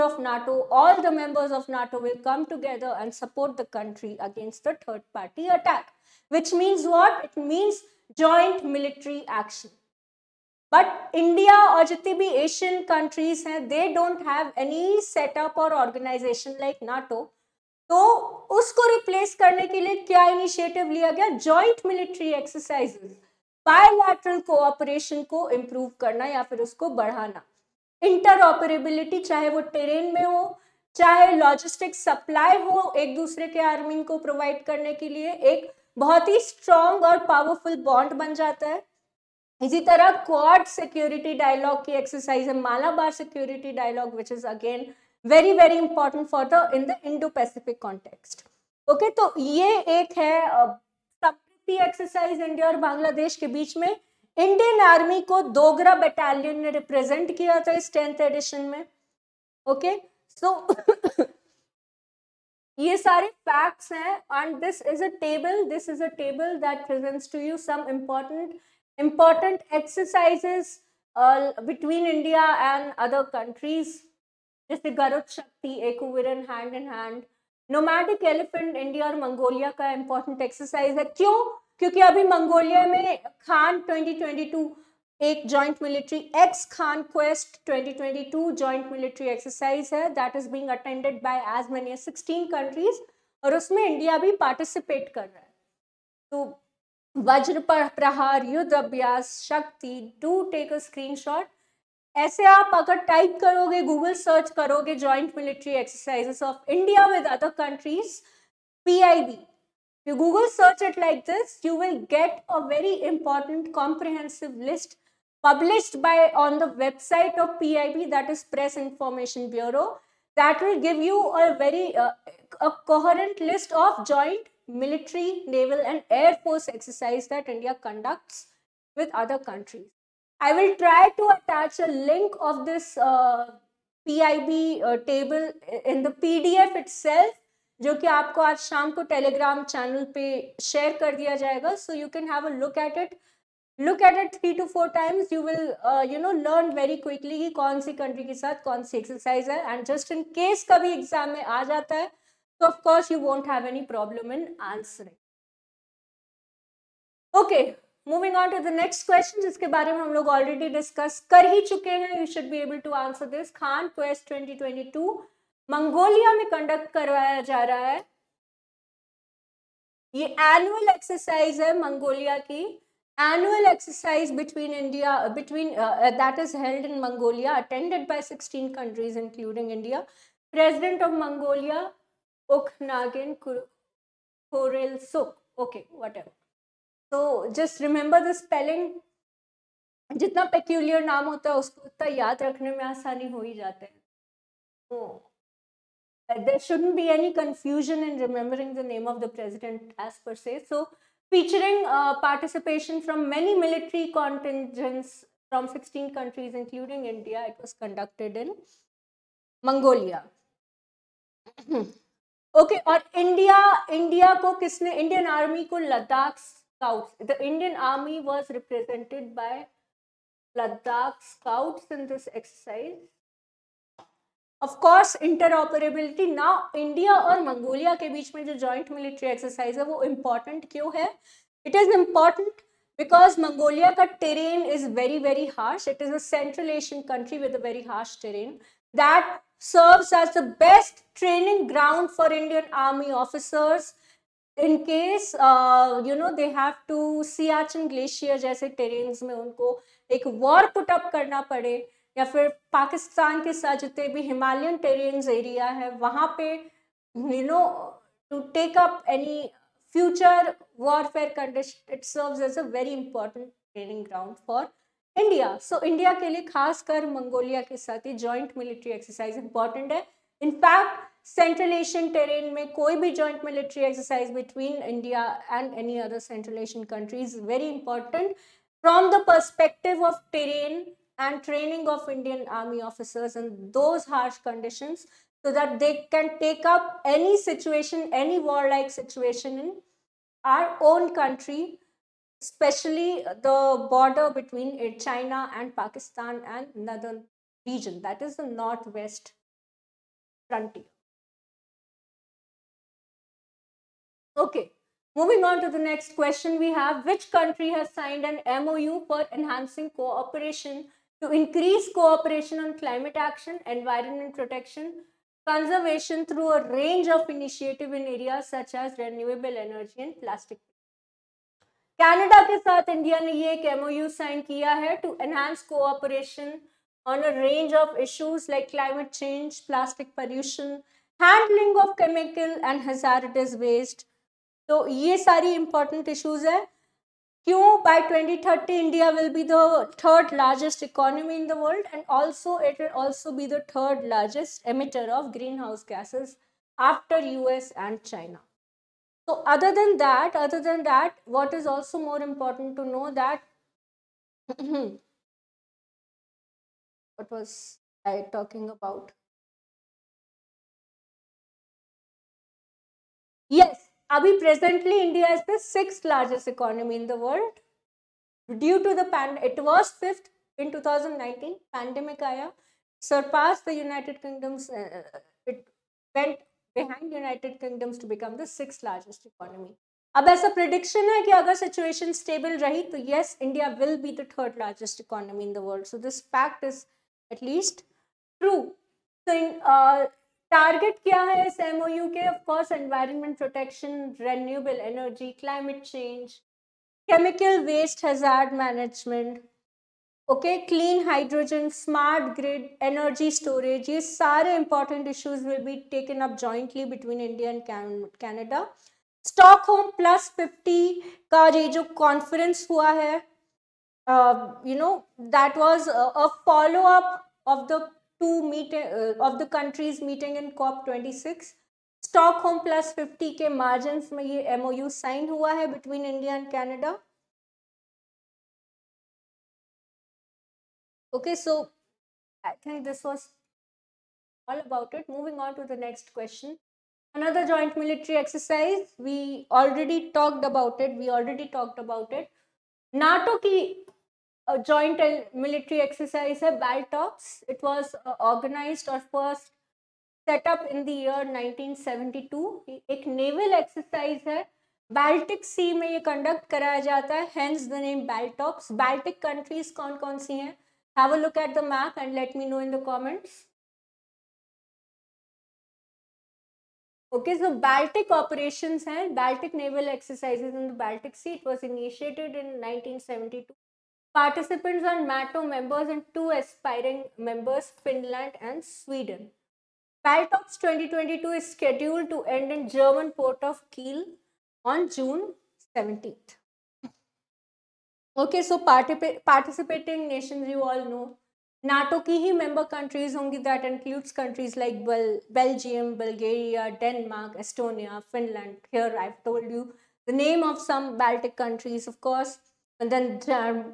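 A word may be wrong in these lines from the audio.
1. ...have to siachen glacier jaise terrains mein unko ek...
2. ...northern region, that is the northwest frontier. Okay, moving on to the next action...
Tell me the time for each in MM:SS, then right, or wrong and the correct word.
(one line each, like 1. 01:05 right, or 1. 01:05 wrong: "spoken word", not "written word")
1. 04:06 right
2. 04:56 wrong: "question", not "action".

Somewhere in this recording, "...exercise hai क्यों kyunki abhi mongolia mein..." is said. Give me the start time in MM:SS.
01:20.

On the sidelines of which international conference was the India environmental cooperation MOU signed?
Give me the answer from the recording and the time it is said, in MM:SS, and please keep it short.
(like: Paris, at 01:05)
Stockholm+50, at 06:49.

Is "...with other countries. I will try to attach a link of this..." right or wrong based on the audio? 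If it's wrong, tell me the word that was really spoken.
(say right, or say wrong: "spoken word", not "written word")
right.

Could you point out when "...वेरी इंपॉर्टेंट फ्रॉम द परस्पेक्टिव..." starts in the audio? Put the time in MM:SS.
04:37.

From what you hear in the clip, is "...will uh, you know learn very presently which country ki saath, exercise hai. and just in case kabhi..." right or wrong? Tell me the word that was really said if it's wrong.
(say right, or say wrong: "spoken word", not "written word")
wrong: "quickly", not "presently".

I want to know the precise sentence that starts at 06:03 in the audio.
Yes, Abhi presently India is the sixth largest economy in the world.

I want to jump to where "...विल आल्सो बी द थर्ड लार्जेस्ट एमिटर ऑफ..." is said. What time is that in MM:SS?
05:42.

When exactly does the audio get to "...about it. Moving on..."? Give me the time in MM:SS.
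07:14.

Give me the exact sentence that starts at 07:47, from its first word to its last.
Okay, so Baltic operations and Baltic naval exercises in the Baltic Sea.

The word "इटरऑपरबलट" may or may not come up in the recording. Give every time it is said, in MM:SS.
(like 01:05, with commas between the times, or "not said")
00:28, 03:45.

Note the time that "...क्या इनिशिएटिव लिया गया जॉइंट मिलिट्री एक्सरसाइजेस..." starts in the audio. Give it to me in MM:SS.
00:20.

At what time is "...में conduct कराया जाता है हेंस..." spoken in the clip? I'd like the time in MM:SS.
07:35.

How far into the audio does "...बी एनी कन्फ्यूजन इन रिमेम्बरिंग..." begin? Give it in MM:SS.
03:16.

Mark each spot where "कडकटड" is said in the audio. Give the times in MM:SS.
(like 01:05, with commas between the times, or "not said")
03:27.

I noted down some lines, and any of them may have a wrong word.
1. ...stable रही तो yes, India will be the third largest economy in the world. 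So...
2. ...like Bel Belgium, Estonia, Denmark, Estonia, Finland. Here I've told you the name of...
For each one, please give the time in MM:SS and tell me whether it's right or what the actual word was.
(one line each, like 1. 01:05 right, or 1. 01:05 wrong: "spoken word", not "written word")
1. 06:22 right
2. 08:14 wrong: "Bulgaria", not "Estonia".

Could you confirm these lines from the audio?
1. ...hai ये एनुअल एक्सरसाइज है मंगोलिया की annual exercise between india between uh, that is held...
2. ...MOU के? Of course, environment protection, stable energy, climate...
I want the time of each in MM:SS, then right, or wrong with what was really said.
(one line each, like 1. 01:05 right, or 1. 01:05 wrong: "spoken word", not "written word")
1. 02:47 right
2. 06:31 wrong: "renewable", not "stable".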